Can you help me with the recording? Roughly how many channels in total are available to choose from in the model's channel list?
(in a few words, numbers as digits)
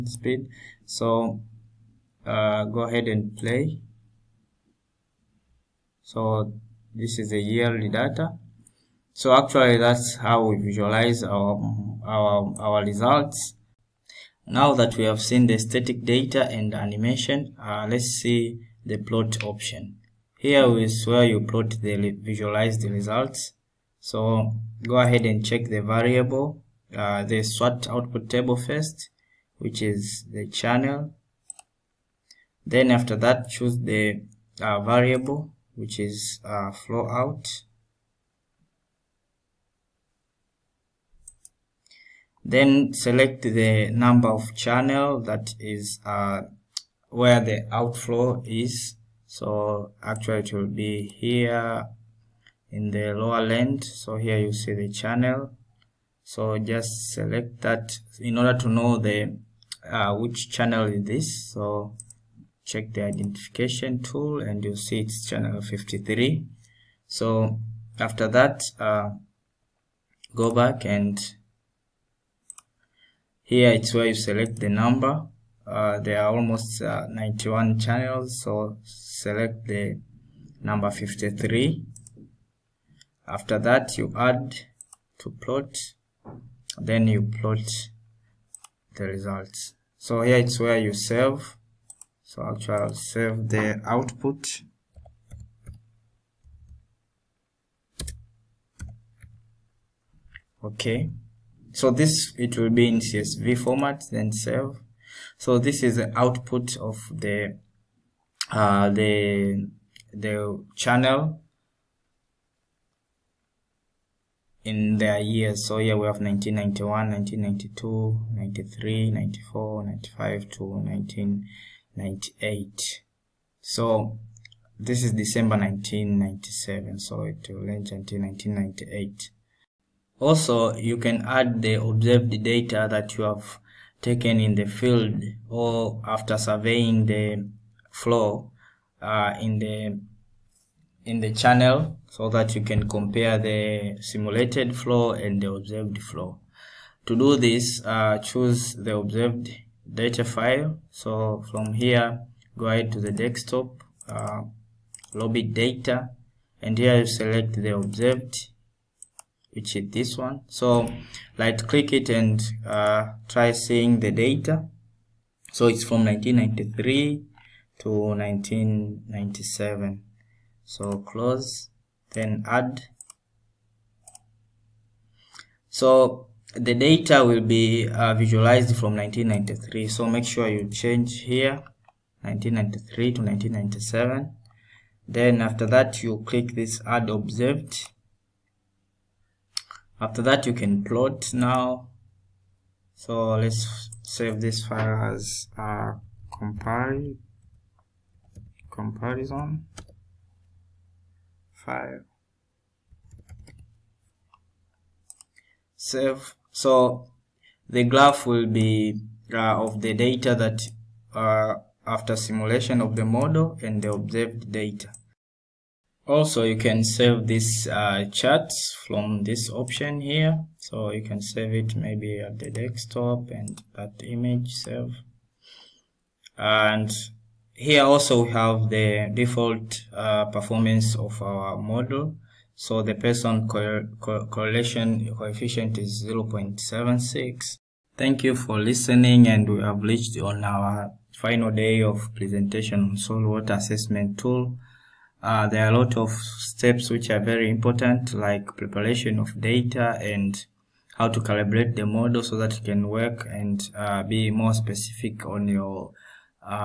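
91.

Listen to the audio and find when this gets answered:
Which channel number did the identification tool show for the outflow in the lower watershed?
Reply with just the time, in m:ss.
1:04.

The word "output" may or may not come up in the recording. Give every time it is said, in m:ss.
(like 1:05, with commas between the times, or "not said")
0:27, 1:33, 1:46.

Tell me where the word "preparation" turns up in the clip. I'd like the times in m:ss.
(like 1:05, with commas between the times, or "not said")
4:08.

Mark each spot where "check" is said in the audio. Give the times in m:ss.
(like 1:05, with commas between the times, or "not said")
0:25, 1:02.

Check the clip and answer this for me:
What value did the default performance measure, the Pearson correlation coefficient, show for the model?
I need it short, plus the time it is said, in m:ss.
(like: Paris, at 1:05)
0.76, at 3:56.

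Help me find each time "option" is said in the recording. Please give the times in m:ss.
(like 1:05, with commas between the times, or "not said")
0:19, 3:39.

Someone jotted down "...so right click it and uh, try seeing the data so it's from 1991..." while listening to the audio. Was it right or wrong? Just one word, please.
wrong.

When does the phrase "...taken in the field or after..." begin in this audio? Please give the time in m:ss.
2:14.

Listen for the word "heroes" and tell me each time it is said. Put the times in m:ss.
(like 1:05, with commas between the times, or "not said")
not said.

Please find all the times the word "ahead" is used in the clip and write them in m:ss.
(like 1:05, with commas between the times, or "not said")
0:02, 0:24, 2:32.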